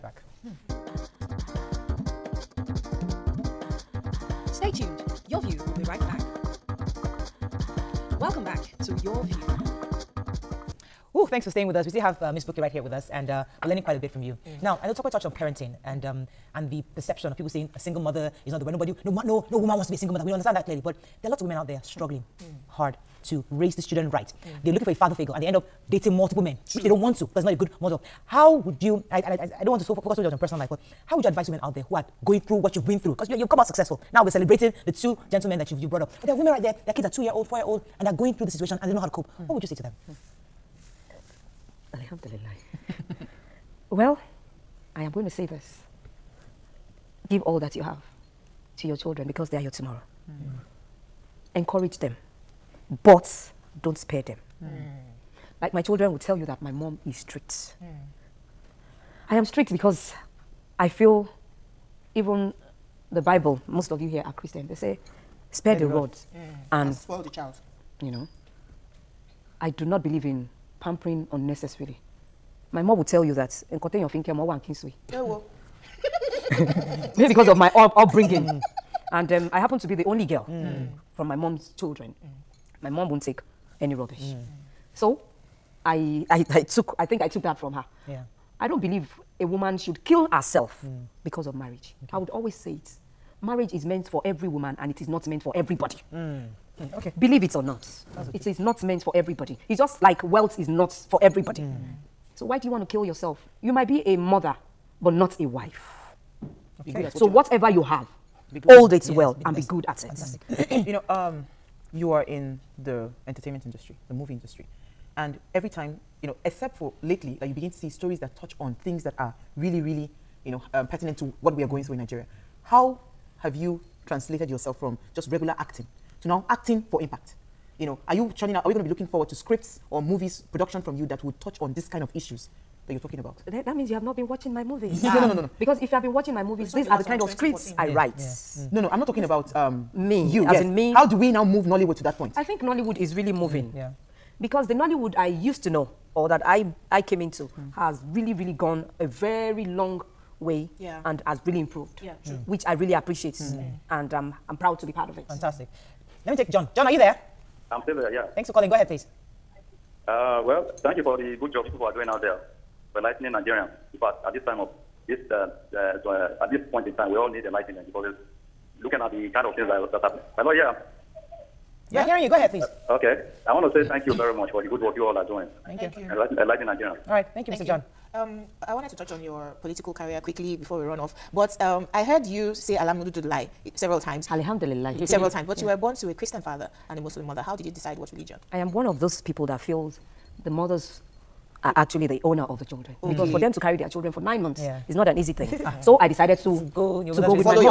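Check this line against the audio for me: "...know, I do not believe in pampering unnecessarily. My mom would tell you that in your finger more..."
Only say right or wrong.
right.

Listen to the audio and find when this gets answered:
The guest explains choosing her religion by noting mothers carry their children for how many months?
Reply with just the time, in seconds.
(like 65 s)
194 s.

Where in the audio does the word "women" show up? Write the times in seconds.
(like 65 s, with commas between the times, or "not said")
21 s, 31 s, 36 s.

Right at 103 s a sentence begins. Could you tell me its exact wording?
You might be a mother, but not a wife.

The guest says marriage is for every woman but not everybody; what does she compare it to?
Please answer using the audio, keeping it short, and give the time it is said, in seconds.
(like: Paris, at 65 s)
wealth, at 100 s.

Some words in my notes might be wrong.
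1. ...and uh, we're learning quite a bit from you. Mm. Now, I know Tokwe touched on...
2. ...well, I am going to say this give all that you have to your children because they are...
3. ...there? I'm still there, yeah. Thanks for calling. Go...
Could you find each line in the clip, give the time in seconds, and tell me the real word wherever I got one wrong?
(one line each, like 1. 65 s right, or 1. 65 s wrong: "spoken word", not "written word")
1. 13 s right
2. 43 s right
3. 156 s right.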